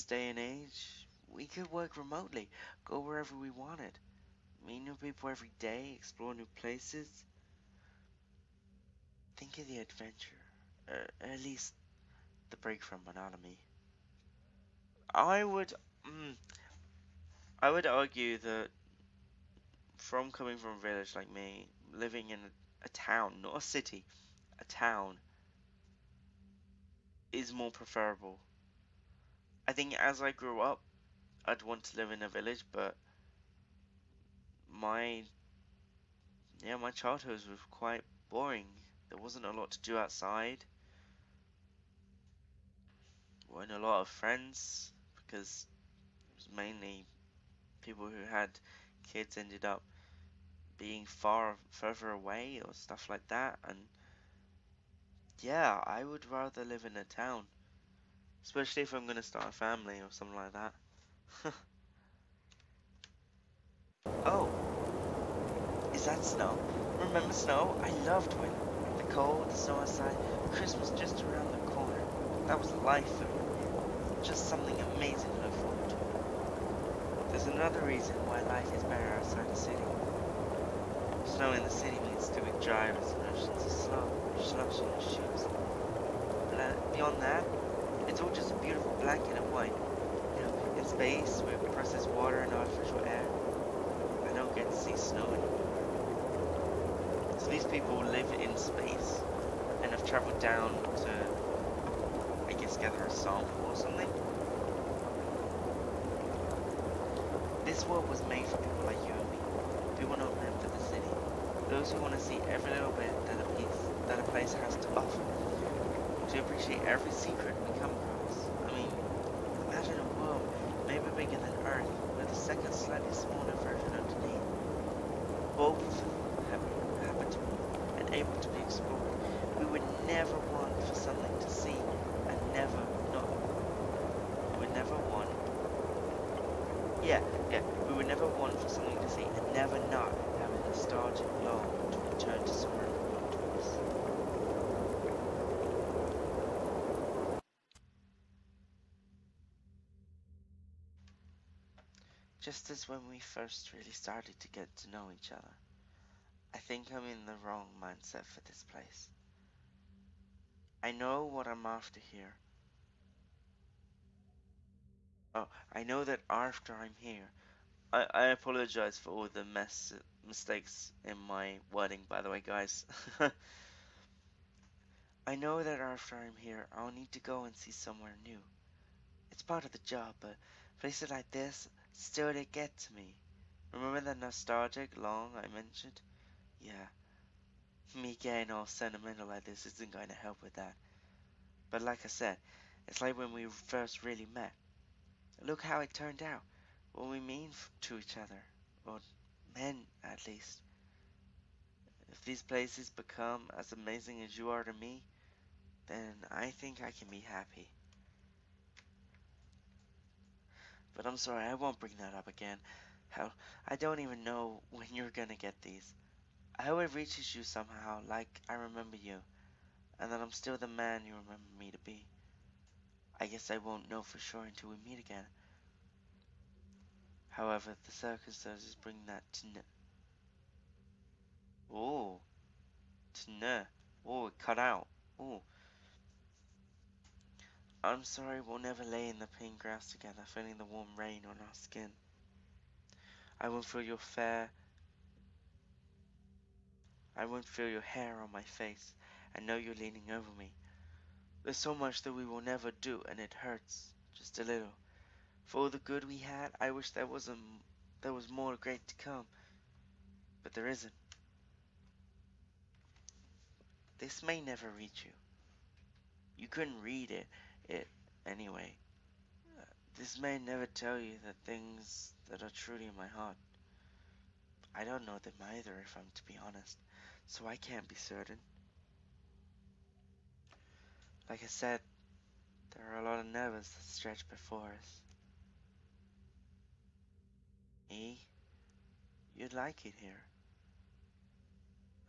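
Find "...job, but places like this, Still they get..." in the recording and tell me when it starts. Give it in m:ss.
2:59.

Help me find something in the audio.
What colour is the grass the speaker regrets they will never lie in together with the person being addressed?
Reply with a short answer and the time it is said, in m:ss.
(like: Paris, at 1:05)
pink, at 3:59.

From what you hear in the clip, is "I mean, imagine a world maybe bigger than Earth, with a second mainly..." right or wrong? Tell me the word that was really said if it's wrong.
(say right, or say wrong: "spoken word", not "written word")
wrong: "slightly", not "mainly".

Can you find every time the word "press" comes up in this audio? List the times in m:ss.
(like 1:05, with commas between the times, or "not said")
not said.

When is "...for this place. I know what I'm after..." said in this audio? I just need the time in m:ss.
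2:38.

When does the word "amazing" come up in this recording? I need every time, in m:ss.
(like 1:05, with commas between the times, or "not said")
1:14, 3:23.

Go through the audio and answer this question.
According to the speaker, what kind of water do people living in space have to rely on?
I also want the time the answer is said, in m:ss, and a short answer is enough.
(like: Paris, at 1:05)
processed water, at 1:31.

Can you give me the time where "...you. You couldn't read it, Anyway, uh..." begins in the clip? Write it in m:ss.
4:25.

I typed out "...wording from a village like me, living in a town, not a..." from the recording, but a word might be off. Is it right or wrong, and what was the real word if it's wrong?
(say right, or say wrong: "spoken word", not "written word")
wrong: "coming", not "wording".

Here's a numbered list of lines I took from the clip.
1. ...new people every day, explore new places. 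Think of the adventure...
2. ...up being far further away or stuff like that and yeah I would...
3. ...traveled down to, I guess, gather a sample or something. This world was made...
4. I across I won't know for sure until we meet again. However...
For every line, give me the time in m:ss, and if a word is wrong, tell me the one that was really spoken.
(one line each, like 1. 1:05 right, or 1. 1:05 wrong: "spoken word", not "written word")
1. 0:04 right
2. 0:49 right
3. 1:40 right
4. 3:43 wrong: "guess", not "across".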